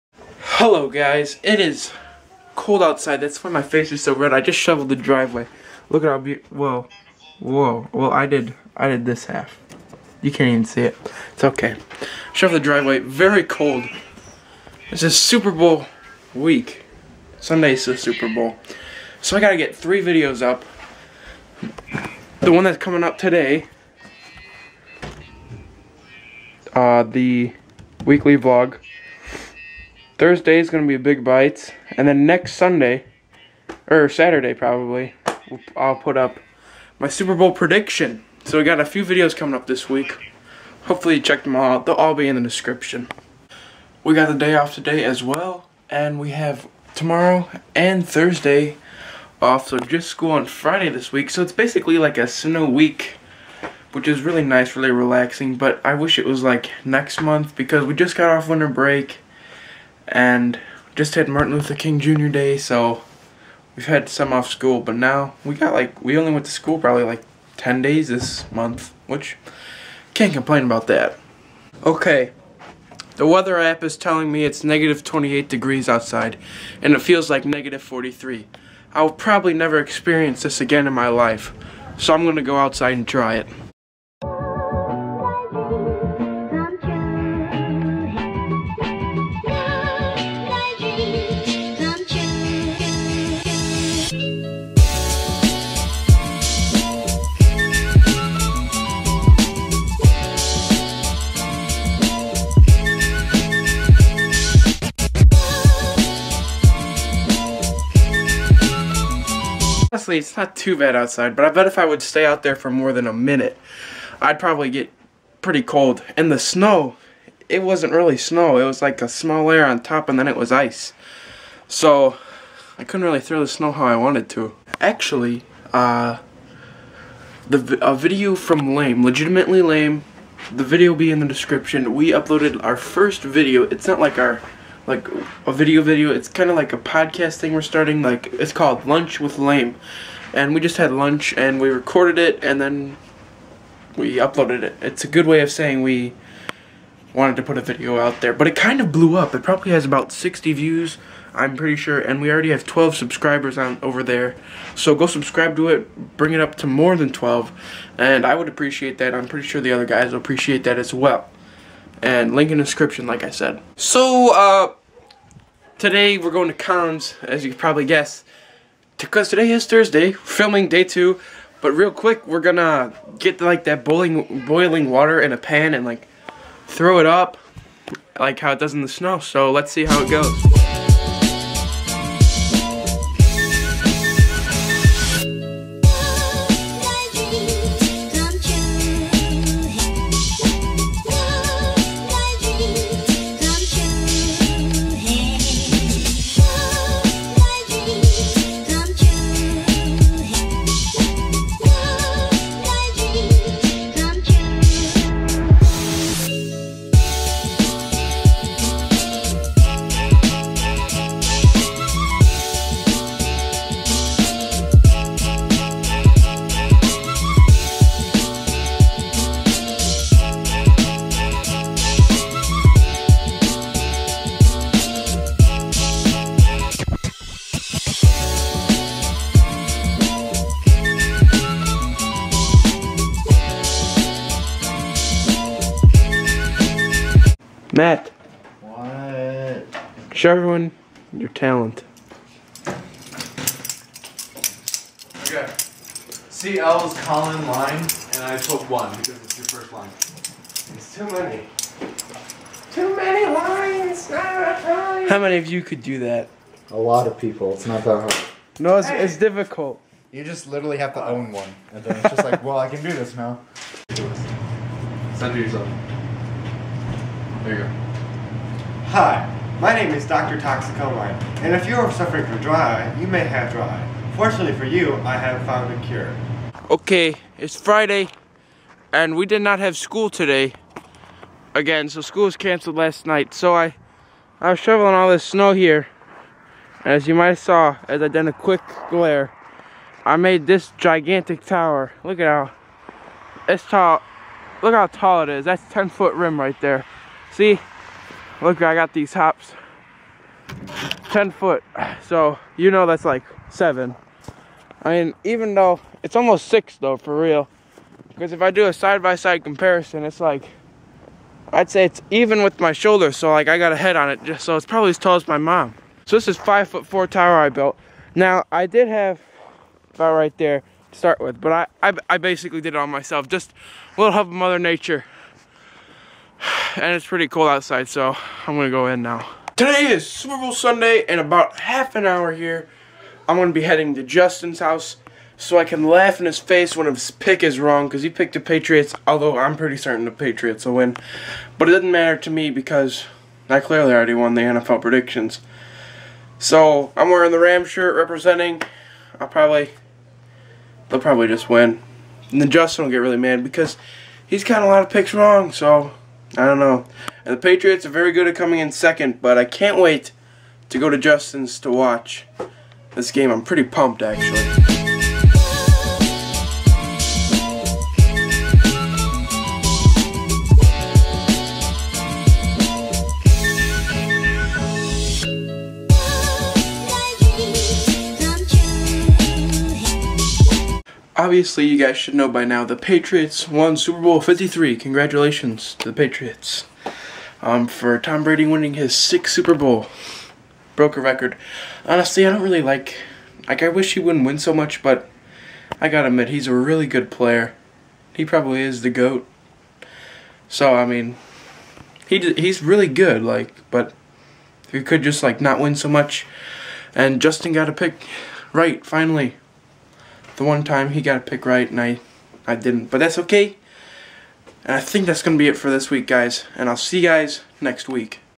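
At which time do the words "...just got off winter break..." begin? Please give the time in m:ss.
0:57.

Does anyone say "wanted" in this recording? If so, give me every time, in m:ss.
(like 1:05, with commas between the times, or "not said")
2:03, 2:27.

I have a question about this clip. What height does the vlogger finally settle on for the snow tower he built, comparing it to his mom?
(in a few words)
5 foot 4.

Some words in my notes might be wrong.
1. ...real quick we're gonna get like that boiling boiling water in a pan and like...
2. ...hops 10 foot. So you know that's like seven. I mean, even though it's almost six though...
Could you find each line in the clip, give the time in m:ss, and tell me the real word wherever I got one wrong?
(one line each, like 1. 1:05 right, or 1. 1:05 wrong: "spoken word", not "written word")
1. 2:51 right
2. 4:59 right.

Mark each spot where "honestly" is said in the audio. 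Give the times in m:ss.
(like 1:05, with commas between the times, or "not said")
1:50, 6:31.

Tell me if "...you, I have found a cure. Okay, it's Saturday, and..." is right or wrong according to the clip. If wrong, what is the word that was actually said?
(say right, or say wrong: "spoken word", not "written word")
wrong: "Friday", not "Saturday".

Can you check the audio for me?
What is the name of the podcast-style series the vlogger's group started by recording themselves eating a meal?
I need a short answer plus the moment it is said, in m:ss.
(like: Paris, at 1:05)
Lunch with Lame, at 2:18.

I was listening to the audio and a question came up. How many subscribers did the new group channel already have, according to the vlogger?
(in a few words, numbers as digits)
12.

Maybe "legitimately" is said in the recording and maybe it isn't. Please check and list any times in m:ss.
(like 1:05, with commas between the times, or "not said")
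2:09.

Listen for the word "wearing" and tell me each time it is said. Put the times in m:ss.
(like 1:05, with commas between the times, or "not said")
5:47.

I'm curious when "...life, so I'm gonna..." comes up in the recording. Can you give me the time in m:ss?
1:21.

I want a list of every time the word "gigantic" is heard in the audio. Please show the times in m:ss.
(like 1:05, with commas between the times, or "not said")
4:50.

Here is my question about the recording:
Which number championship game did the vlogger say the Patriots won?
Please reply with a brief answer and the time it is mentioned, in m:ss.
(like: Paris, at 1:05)
Super Bowl 53, at 6:23.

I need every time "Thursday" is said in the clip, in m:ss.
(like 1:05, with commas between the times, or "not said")
0:30, 0:48, 2:49.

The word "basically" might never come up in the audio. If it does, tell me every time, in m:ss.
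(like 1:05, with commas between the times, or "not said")
0:51, 5:22.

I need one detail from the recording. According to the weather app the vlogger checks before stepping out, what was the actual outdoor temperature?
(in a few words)
-28 degrees.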